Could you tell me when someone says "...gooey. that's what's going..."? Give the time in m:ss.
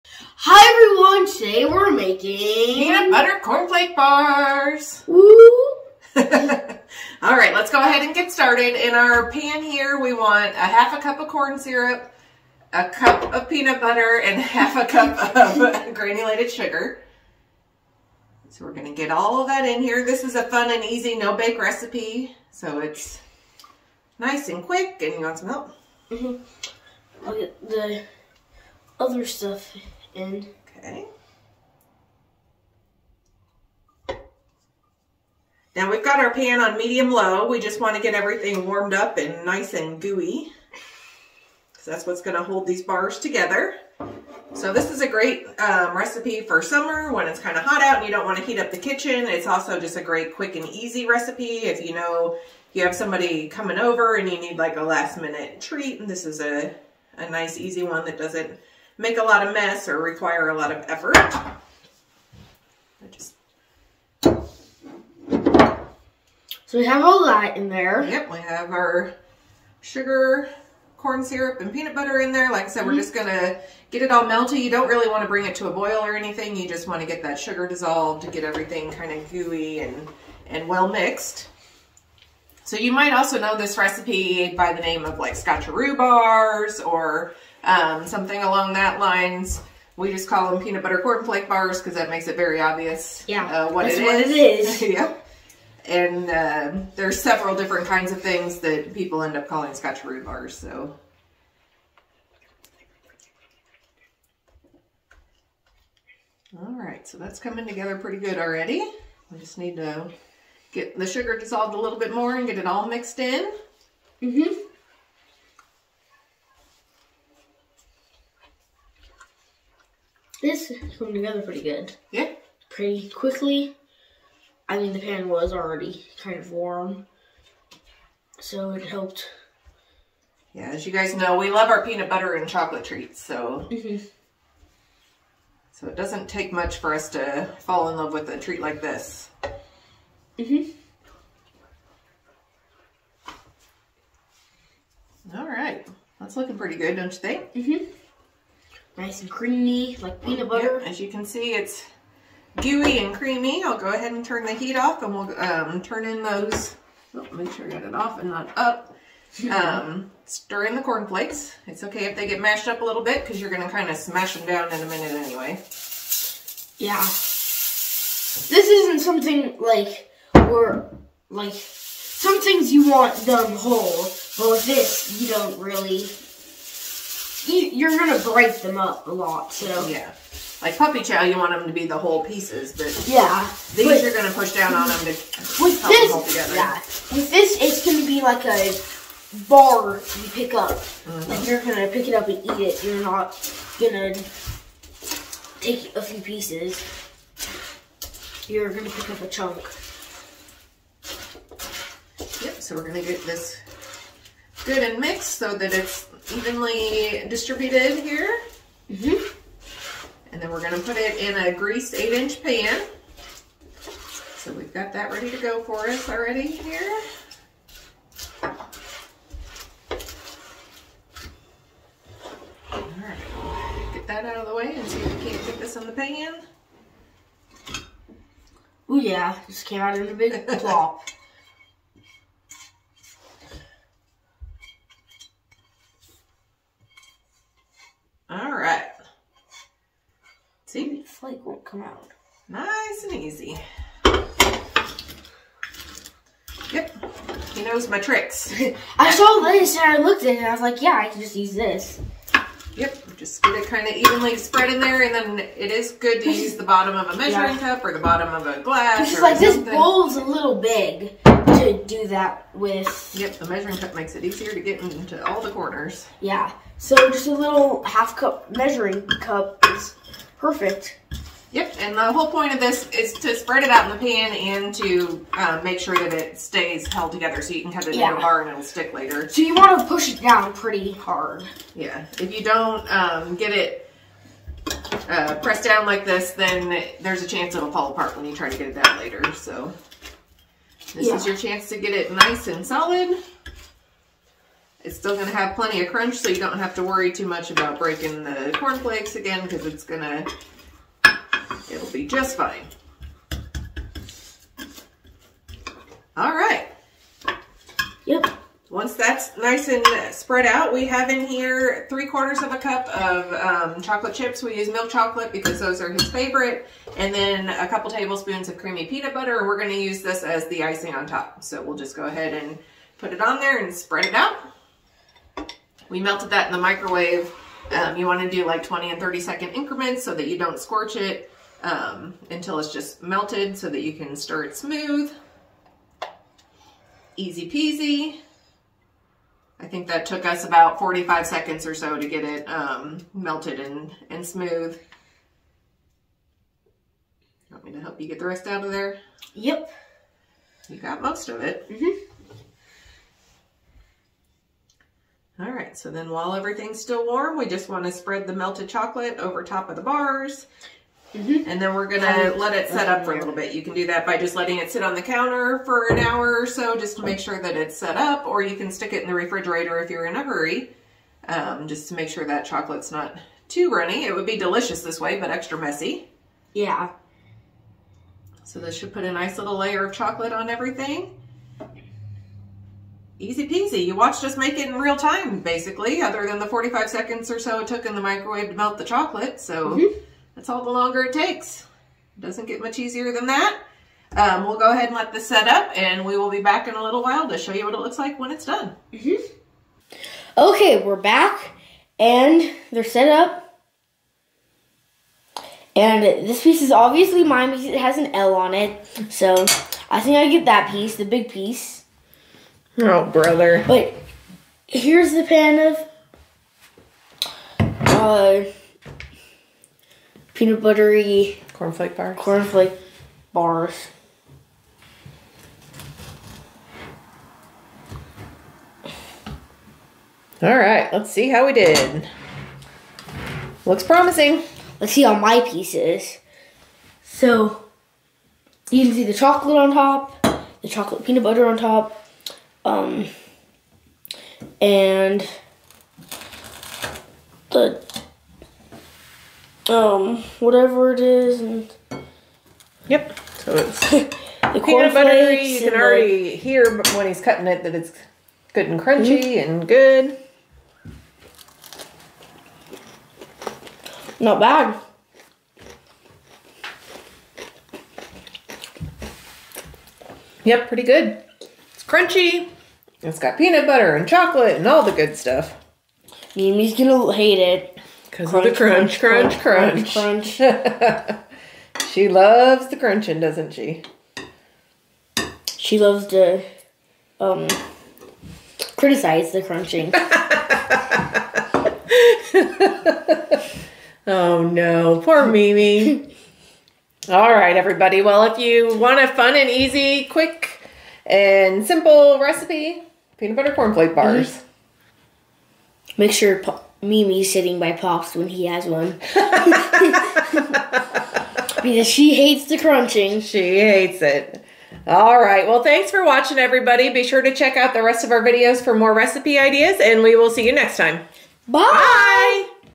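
0:40.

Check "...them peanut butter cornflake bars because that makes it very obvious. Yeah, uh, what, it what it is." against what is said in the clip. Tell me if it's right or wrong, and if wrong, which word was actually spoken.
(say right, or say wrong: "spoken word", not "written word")
right.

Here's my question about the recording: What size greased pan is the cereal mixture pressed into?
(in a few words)
8 inch.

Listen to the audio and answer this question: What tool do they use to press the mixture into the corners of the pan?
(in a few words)
half cup measuring cup.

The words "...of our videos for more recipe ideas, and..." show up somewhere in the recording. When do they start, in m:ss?
8:38.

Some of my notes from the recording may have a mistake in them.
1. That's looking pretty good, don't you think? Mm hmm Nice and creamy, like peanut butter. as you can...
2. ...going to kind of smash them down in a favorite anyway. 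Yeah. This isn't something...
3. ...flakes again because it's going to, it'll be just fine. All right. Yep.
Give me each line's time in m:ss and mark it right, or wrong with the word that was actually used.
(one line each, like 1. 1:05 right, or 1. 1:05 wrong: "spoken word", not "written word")
1. 2:26 right
2. 2:43 wrong: "minute", not "favorite"
3. 4:58 right.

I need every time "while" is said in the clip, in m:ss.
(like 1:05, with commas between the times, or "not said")
5:56, 6:37.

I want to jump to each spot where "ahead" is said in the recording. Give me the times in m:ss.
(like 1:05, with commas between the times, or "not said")
0:07, 2:33, 5:22, 6:34.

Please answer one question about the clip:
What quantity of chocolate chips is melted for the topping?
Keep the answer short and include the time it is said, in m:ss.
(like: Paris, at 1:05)
3/4 cup, at 5:11.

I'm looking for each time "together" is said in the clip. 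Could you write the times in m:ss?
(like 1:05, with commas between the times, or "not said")
0:43, 1:47, 2:01, 3:06, 4:37.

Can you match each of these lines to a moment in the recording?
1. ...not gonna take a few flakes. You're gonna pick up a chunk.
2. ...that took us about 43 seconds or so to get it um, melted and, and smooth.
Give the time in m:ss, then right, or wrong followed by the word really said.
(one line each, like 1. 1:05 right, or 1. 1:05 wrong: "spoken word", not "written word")
1. 3:13 wrong: "pieces", not "flakes"
2. 5:39 wrong: "45", not "43".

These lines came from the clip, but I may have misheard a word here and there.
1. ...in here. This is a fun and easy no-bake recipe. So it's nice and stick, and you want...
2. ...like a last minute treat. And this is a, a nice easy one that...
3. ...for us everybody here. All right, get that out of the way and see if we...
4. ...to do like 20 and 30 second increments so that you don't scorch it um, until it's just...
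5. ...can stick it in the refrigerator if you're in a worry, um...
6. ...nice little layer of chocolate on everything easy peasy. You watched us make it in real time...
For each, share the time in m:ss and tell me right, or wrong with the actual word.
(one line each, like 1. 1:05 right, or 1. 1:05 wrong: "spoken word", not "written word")
1. 0:19 wrong: "quick", not "stick"
2. 0:54 right
3. 3:35 wrong: "already", not "everybody"
4. 5:28 right
5. 6:08 wrong: "hurry", not "worry"
6. 6:19 right.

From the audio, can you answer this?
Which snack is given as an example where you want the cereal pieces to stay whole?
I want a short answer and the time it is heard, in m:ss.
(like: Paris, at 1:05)
puppy chow, at 3:00.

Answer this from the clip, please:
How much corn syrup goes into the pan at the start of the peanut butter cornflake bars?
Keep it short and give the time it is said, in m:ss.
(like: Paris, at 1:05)
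1/2 cup, at 0:10.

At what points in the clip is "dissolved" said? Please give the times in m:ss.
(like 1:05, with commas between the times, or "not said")
1:17, 1:51.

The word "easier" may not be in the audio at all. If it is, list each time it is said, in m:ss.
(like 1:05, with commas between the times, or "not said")
4:24, 6:32.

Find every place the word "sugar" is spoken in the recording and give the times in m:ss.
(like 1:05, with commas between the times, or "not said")
0:16, 1:09, 1:17, 1:51.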